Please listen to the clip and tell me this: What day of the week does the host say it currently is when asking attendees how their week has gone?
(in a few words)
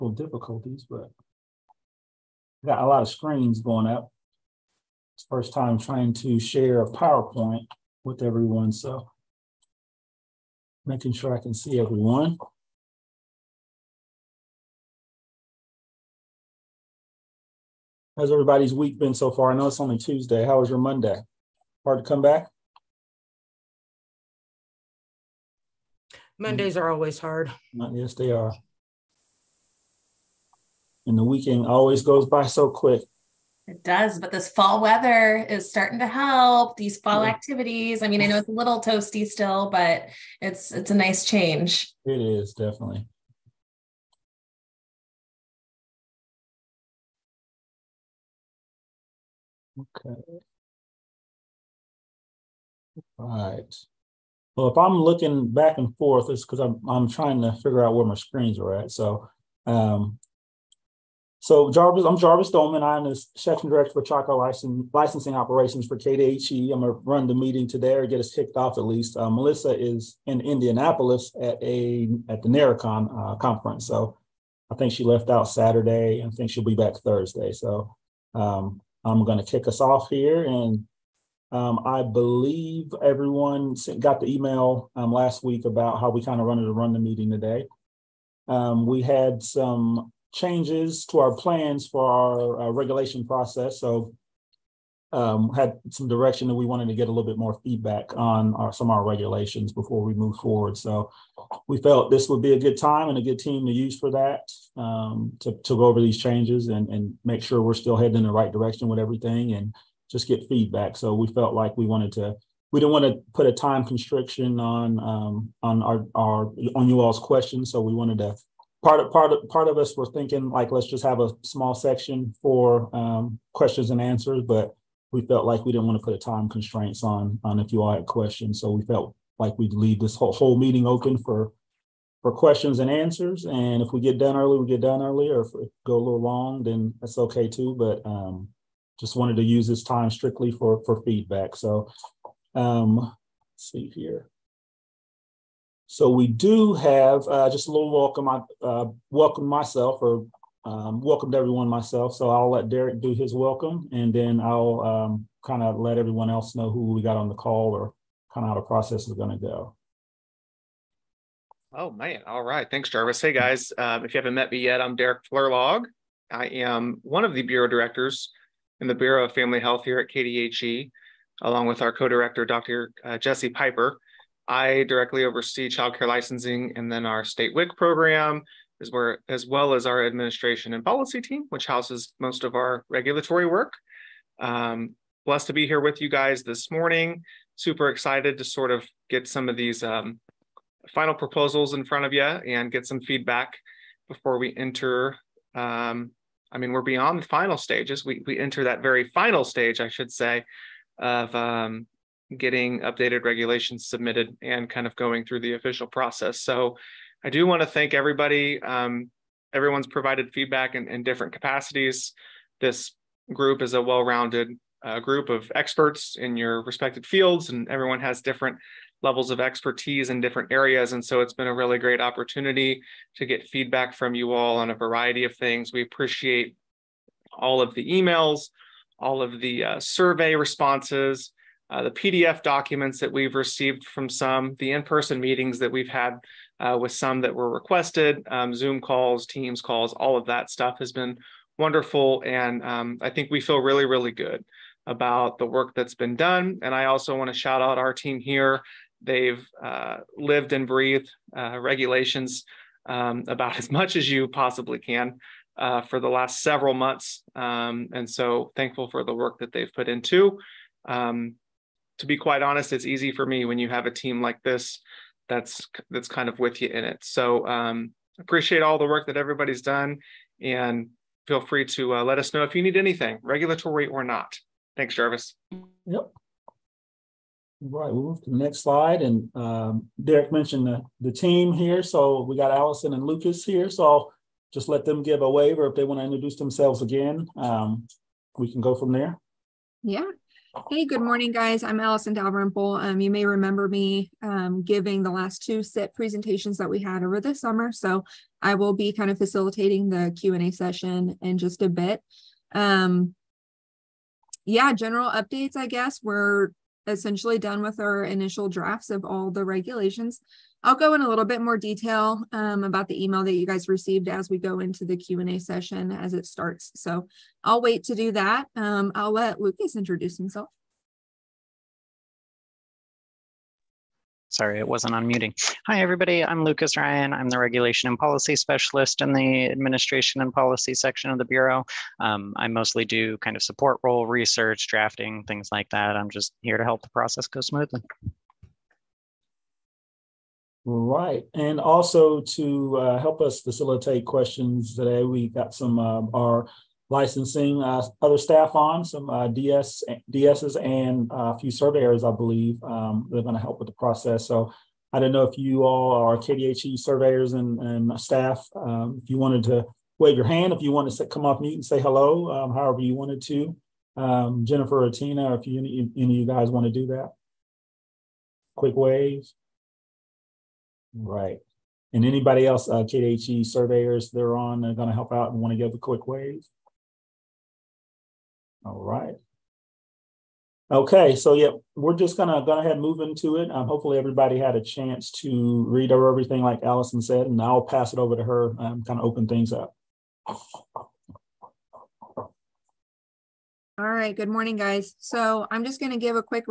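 Tuesday.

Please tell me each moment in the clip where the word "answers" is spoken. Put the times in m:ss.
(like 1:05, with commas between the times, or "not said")
2:04, 2:12.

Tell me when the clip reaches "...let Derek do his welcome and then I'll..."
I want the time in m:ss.
2:32.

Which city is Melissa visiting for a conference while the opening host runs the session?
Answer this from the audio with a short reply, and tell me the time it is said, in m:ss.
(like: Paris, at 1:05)
Indianapolis, at 1:10.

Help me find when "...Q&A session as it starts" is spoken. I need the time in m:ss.
5:14.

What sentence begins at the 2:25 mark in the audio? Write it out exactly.
So we do have uh, just a little welcome.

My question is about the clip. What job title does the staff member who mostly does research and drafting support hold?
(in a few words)
Regulation and Policy Specialist.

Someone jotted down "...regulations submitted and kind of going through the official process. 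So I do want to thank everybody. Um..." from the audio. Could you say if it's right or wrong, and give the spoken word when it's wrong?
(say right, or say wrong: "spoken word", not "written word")
right.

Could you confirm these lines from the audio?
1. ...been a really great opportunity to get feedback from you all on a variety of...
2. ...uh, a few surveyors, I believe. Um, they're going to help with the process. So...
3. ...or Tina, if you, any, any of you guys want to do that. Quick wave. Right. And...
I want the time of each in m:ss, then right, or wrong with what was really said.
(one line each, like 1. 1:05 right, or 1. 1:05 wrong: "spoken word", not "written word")
1. 3:41 right
2. 5:51 right
3. 6:04 right.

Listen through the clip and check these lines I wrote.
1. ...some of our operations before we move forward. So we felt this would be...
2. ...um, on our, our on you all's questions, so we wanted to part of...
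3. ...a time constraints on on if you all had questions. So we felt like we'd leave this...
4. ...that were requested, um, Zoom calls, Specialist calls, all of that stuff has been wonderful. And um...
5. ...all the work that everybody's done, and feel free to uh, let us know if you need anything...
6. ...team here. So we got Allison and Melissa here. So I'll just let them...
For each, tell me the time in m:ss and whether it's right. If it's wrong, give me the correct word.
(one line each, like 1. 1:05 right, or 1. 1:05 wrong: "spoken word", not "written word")
1. 1:38 wrong: "regulations", not "operations"
2. 1:54 right
3. 2:06 right
4. 3:57 wrong: "Teams", not "Specialist"
5. 4:28 right
6. 4:41 wrong: "Lucas", not "Melissa".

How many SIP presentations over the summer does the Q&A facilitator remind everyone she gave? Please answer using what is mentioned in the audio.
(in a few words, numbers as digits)
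2.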